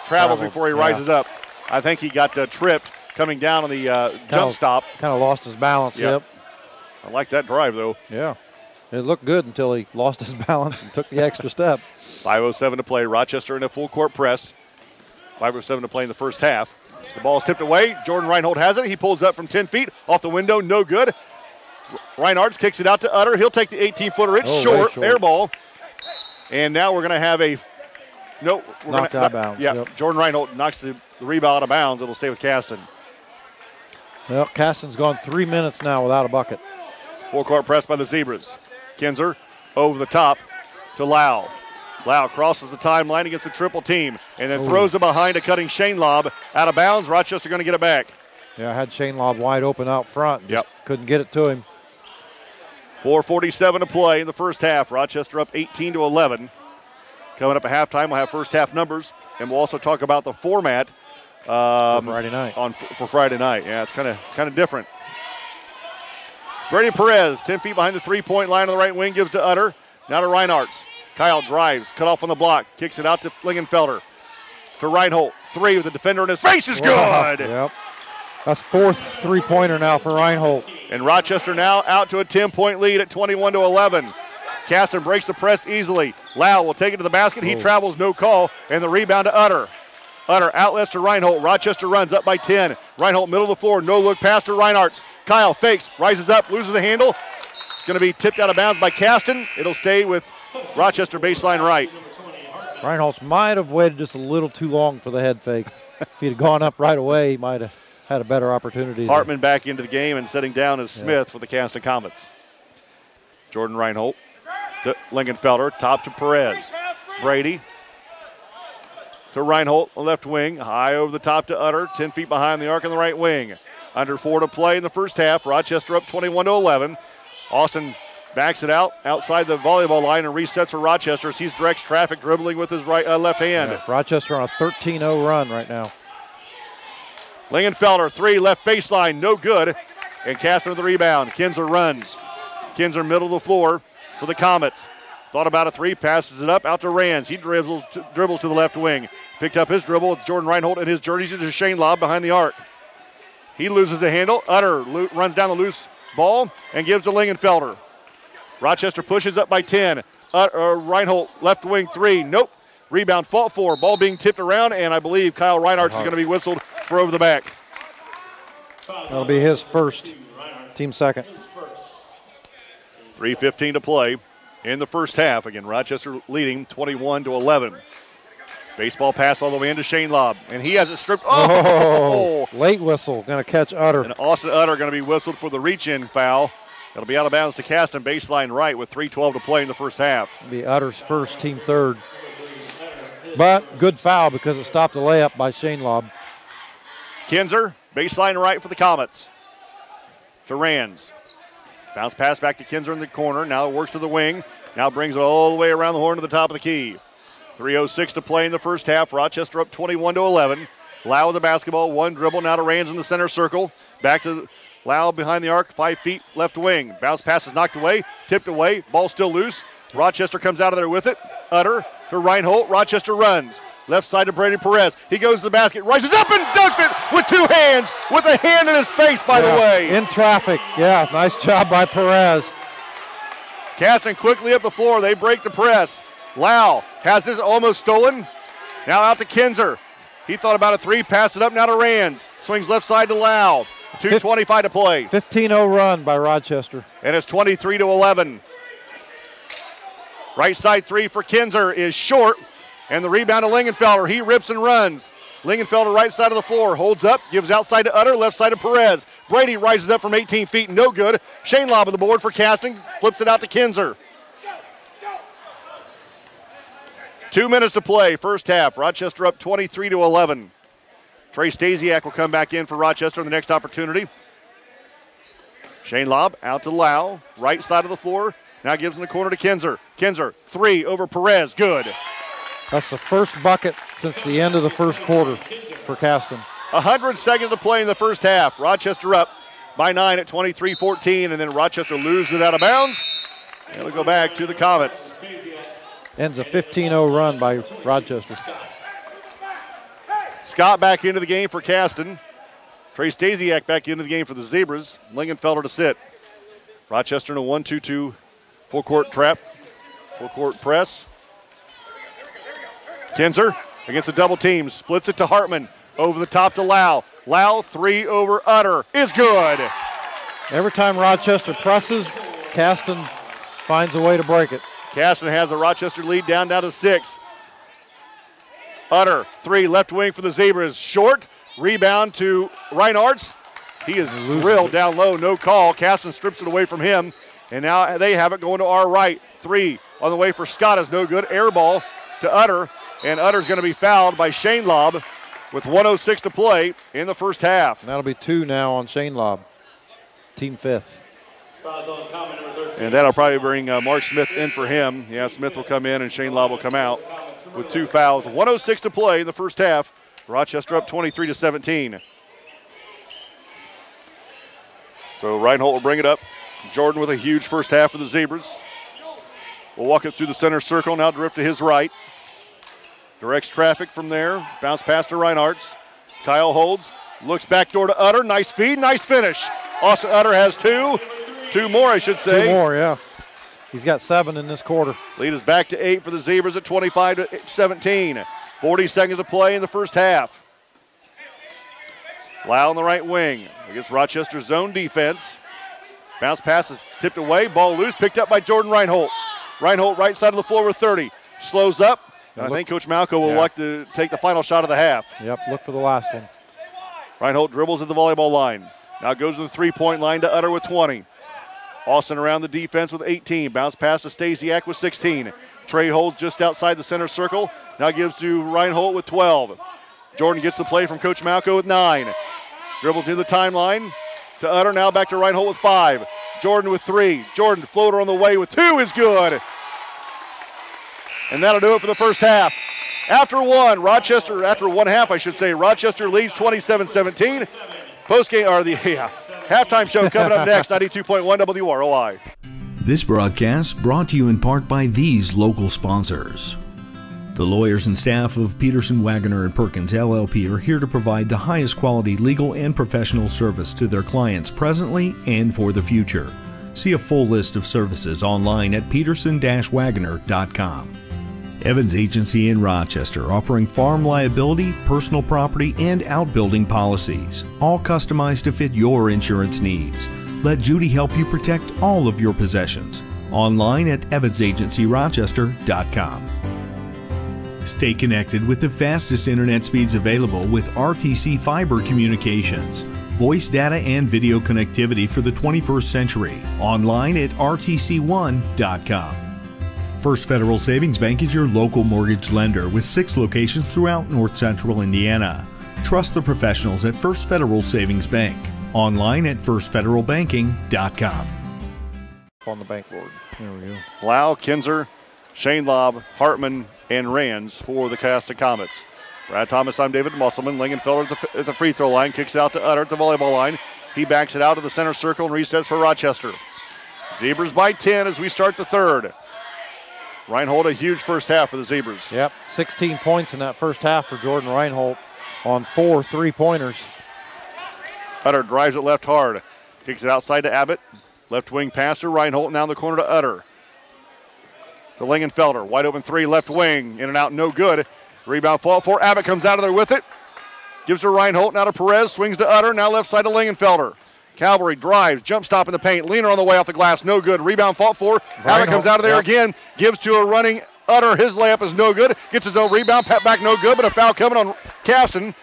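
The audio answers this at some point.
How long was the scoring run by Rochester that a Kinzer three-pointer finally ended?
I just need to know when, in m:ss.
4:56.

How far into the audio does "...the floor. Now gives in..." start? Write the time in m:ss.
4:37.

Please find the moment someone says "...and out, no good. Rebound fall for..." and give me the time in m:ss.
8:57.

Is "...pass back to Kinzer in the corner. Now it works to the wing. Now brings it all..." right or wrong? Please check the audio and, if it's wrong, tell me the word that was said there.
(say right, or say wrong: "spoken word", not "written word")
right.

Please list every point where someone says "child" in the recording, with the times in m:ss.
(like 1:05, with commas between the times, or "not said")
not said.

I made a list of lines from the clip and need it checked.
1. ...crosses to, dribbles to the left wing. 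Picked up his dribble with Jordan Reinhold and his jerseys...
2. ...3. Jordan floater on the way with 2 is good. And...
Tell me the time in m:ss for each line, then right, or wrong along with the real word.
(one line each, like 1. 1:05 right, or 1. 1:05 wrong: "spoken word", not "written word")
1. 2:27 wrong: "dribbles", not "crosses"
2. 7:06 right.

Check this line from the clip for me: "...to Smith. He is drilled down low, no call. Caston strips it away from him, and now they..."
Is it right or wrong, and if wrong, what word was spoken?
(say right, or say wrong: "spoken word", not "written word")
wrong: "Reinhardt", not "Smith".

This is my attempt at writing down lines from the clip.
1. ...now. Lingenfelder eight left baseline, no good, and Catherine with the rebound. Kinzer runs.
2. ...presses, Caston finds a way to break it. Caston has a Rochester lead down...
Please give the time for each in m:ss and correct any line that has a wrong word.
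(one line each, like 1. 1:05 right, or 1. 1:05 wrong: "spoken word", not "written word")
1. 2:15 wrong: "three", not "eight"
2. 5:21 right.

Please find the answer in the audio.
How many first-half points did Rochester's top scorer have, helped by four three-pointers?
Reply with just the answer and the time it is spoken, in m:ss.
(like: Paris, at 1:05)
16, at 8:42.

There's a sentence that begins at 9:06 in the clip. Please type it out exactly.
Leaner on the way off the glass, no good.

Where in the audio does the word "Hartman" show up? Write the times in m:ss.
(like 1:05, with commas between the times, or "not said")
1:49, 5:15, 8:26.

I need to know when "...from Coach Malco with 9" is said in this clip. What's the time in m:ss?
7:00.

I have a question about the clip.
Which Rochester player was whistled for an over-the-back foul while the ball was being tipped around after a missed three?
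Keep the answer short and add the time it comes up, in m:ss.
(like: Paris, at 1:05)
Kyle Reinhardt, at 2:45.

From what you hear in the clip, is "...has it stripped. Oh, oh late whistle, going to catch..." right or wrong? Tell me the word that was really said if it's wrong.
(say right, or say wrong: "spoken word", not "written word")
right.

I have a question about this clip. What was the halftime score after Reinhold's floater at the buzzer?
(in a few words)
27-17.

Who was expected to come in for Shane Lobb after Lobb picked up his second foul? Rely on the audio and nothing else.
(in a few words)
Mark Smith.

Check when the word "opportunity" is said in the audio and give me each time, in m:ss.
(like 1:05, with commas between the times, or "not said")
1:48, 4:33.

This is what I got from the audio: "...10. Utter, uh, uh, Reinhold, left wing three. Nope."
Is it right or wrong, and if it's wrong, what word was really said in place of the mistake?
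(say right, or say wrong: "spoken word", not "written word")
right.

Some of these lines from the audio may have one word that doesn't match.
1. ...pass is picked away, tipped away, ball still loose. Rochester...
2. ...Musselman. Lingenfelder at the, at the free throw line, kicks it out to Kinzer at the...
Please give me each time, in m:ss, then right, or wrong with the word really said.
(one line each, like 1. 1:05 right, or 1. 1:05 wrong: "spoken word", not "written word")
1. 3:37 wrong: "knocked", not "picked"
2. 8:30 wrong: "Utter", not "Kinzer".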